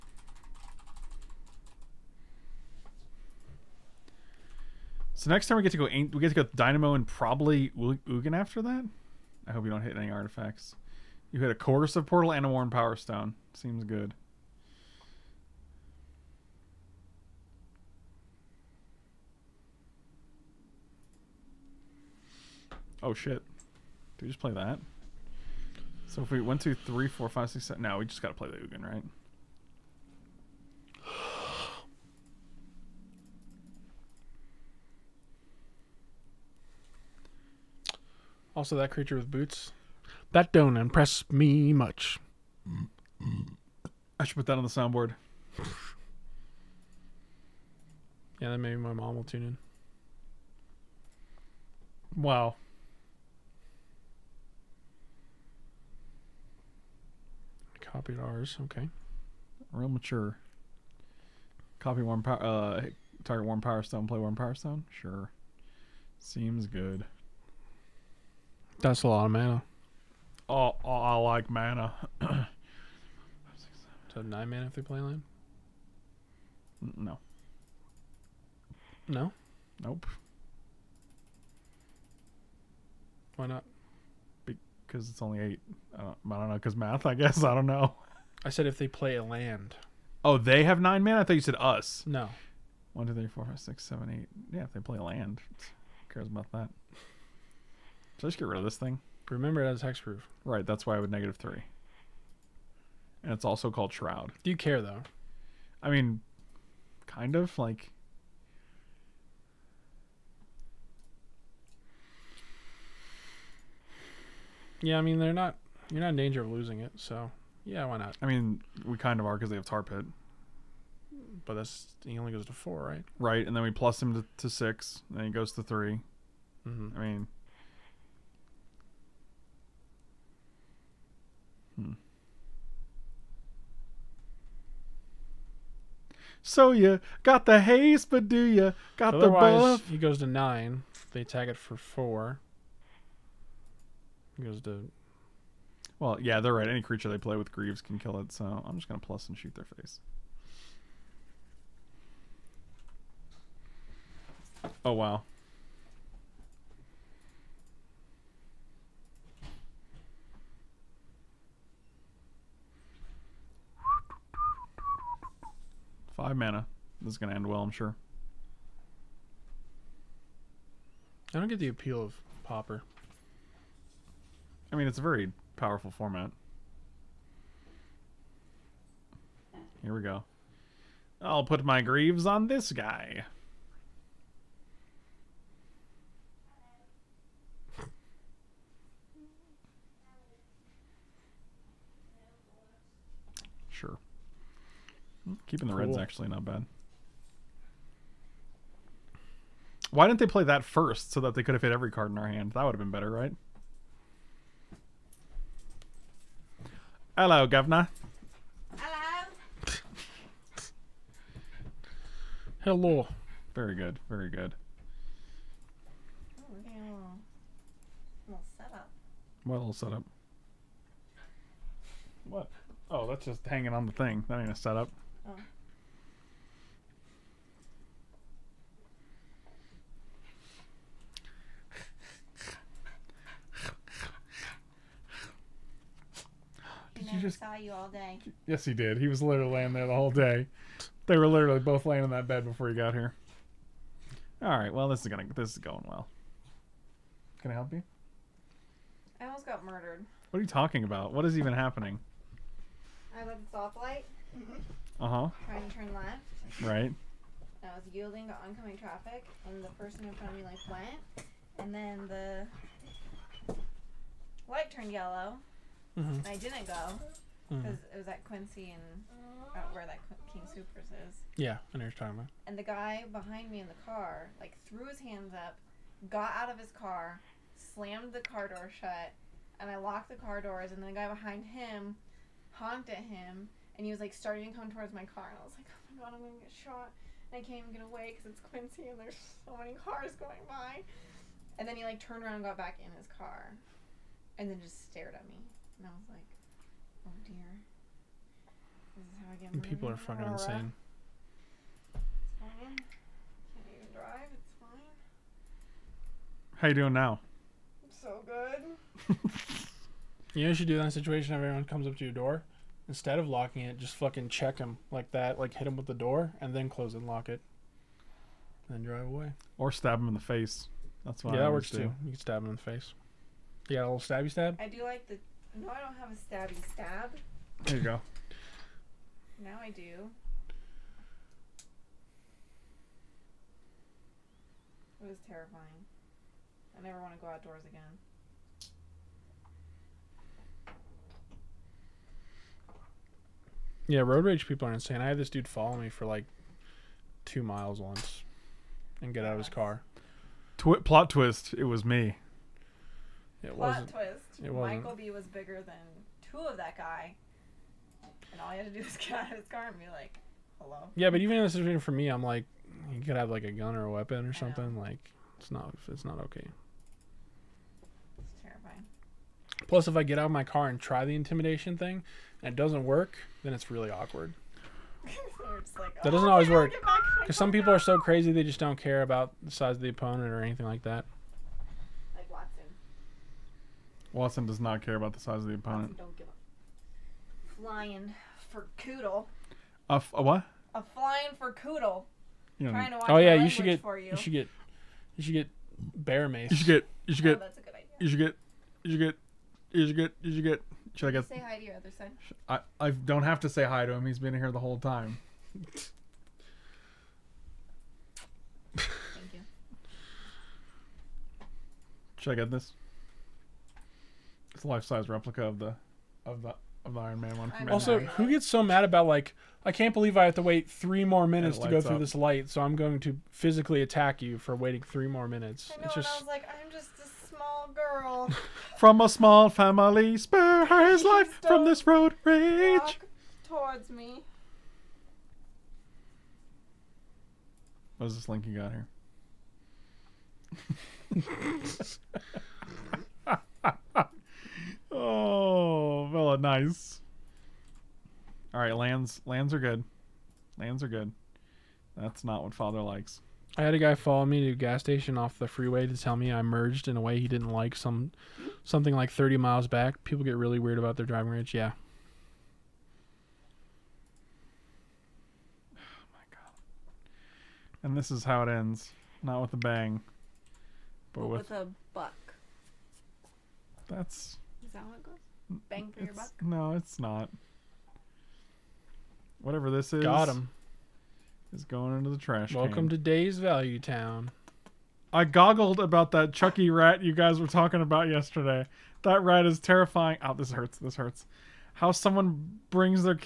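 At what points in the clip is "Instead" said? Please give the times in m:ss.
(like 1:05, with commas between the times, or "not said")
5:12.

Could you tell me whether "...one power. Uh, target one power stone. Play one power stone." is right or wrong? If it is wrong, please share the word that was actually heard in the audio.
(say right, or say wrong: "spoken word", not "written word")
right.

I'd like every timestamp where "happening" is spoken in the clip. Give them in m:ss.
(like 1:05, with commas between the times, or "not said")
4:11.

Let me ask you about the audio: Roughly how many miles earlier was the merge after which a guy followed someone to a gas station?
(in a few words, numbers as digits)
30.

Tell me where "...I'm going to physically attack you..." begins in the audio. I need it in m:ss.
7:02.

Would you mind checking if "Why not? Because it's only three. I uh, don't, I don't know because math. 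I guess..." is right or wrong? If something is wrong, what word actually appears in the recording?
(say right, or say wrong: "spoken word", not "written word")
wrong: "eight", not "three".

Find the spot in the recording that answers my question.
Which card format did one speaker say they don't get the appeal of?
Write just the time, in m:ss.
2:52.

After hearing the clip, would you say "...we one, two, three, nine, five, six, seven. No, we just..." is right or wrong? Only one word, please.
wrong.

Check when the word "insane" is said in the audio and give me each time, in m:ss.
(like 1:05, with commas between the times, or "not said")
5:00, 5:44.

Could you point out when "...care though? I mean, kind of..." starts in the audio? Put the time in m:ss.
1:44.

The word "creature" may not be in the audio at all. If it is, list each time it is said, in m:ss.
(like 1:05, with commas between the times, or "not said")
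0:38, 2:26.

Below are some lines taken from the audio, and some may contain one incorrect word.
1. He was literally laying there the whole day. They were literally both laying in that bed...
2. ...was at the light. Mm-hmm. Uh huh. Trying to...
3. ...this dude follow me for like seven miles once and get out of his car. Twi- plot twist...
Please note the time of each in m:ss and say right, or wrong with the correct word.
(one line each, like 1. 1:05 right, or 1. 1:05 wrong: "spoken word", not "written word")
1. 3:58 right
2. 4:13 wrong: "stoplight", not "light"
3. 5:45 wrong: "two", not "seven".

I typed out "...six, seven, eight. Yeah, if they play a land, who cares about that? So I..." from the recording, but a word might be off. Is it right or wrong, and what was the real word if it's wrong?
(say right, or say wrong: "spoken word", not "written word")
right.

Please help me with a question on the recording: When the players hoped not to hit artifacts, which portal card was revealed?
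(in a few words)
Coercive Portal.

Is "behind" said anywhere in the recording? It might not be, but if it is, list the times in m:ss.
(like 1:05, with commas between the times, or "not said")
4:33, 4:41.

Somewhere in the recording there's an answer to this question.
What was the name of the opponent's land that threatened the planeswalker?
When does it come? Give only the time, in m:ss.
1:59.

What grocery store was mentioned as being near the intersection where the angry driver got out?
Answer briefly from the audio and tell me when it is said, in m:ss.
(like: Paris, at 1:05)
King Supers, at 4:30.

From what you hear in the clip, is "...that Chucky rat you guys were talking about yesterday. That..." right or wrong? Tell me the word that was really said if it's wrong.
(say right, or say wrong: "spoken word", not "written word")
right.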